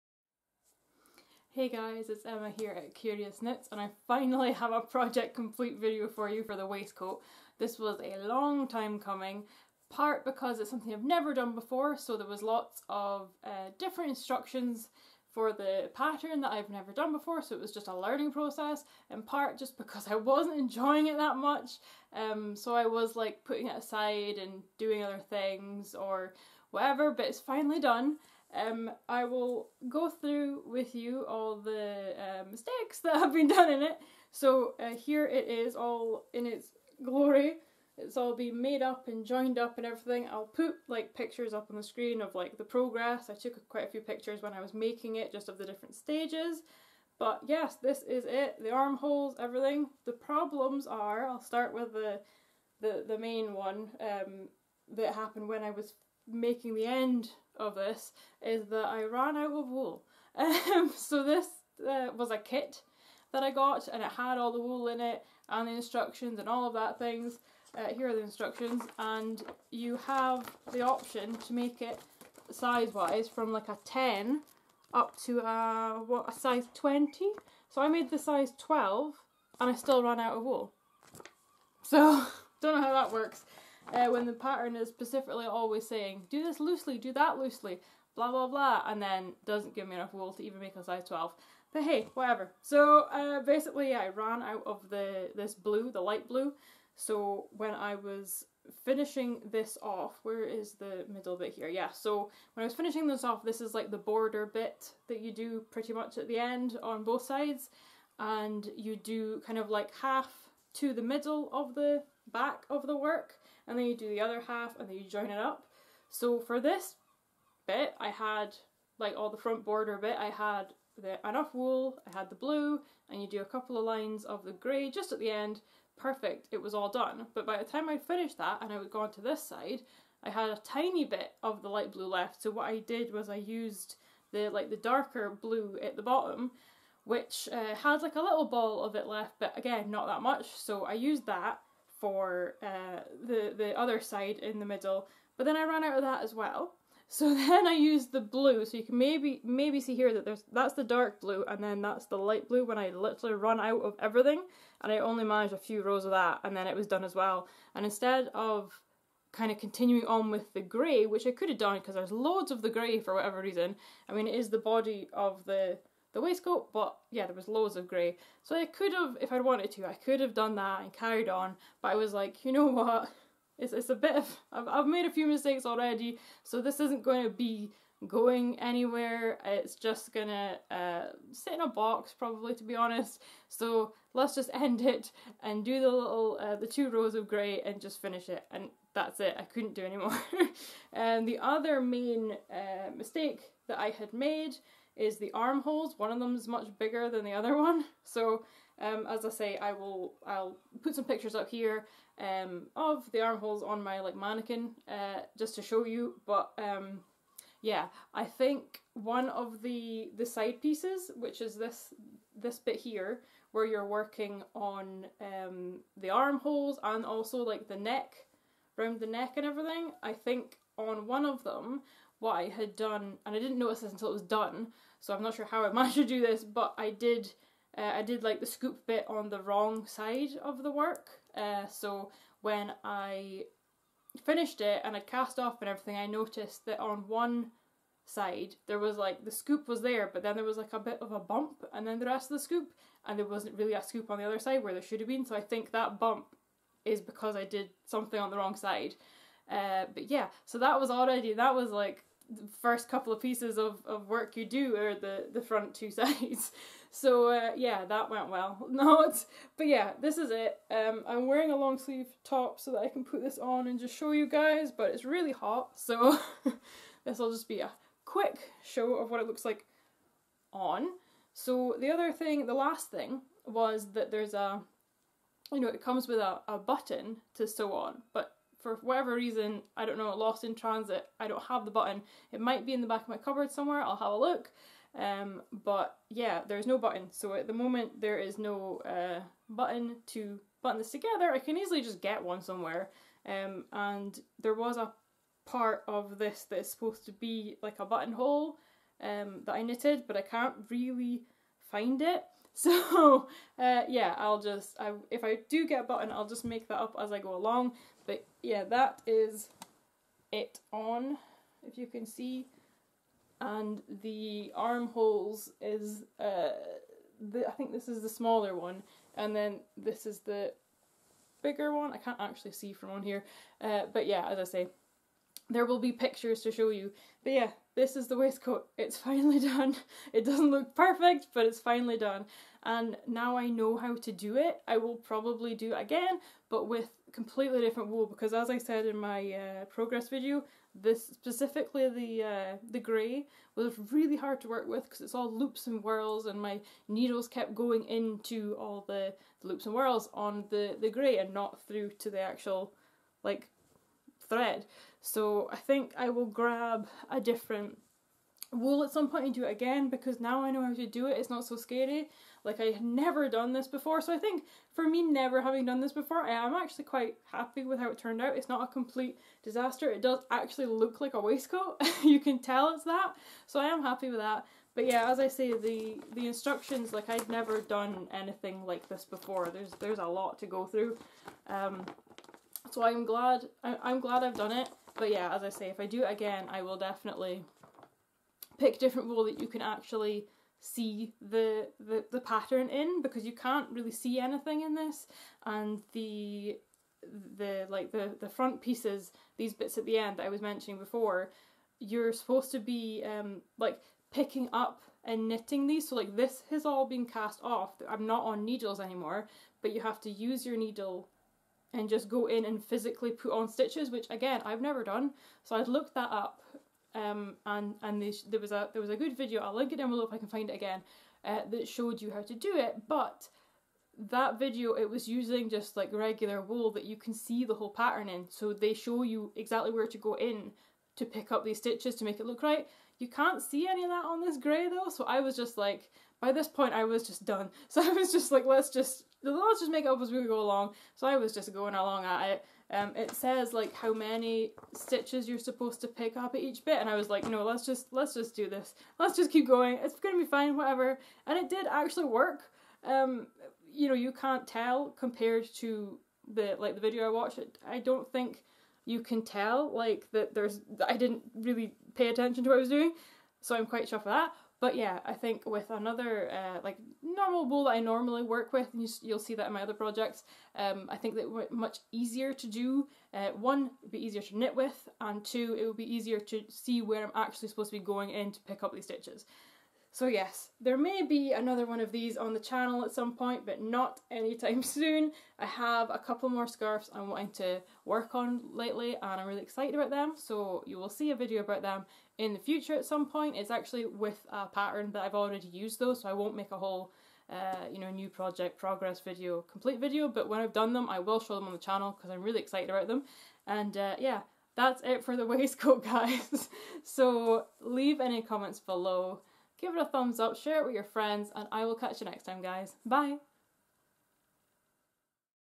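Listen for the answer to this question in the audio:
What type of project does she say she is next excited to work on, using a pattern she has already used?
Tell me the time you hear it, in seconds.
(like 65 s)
486 s.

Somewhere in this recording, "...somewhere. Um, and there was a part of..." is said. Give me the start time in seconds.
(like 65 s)
292 s.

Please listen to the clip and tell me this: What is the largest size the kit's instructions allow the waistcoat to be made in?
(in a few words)
20.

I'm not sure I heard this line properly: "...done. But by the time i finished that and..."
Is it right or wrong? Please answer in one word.
right.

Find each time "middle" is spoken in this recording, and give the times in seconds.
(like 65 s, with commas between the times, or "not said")
101 s, 111 s, 144 s.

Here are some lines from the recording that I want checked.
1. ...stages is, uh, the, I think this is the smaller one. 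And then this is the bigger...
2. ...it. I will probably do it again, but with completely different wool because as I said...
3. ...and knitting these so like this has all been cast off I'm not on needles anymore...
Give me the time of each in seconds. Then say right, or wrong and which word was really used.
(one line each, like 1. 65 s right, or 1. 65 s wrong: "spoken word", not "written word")
1. 314 s wrong: "armholes", not "stages"
2. 334 s right
3. 405 s right.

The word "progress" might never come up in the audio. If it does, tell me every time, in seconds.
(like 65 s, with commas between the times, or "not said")
42 s, 339 s, 498 s.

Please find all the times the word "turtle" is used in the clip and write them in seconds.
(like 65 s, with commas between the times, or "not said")
not said.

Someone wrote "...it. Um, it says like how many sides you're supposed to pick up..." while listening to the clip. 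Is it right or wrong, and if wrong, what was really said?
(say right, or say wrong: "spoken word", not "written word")
wrong: "stitches", not "sides".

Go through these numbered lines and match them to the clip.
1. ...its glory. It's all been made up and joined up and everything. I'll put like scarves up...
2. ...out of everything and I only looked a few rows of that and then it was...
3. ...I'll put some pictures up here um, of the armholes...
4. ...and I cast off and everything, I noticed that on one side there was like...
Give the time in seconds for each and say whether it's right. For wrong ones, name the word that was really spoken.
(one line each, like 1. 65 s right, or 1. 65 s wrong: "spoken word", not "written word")
1. 36 s wrong: "pictures", not "scarves"
2. 153 s wrong: "managed", not "looked"
3. 200 s right
4. 234 s right.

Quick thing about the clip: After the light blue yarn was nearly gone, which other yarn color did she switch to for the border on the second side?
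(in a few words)
darker blue.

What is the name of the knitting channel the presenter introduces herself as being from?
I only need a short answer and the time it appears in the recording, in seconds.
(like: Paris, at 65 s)
Kurious Knits, at 2 s.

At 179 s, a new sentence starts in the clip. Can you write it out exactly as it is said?
It's just gonna uh, sit in a box, probably, to be honest.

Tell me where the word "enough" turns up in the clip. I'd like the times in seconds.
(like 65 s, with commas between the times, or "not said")
89 s, 121 s.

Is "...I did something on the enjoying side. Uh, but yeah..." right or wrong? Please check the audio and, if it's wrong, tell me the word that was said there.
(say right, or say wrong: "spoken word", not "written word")
wrong: "wrong", not "enjoying".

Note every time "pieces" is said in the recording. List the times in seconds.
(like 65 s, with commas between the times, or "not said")
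210 s, 253 s, 398 s.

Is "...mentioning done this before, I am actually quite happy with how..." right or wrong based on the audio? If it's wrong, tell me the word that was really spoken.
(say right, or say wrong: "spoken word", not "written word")
wrong: "having", not "mentioning".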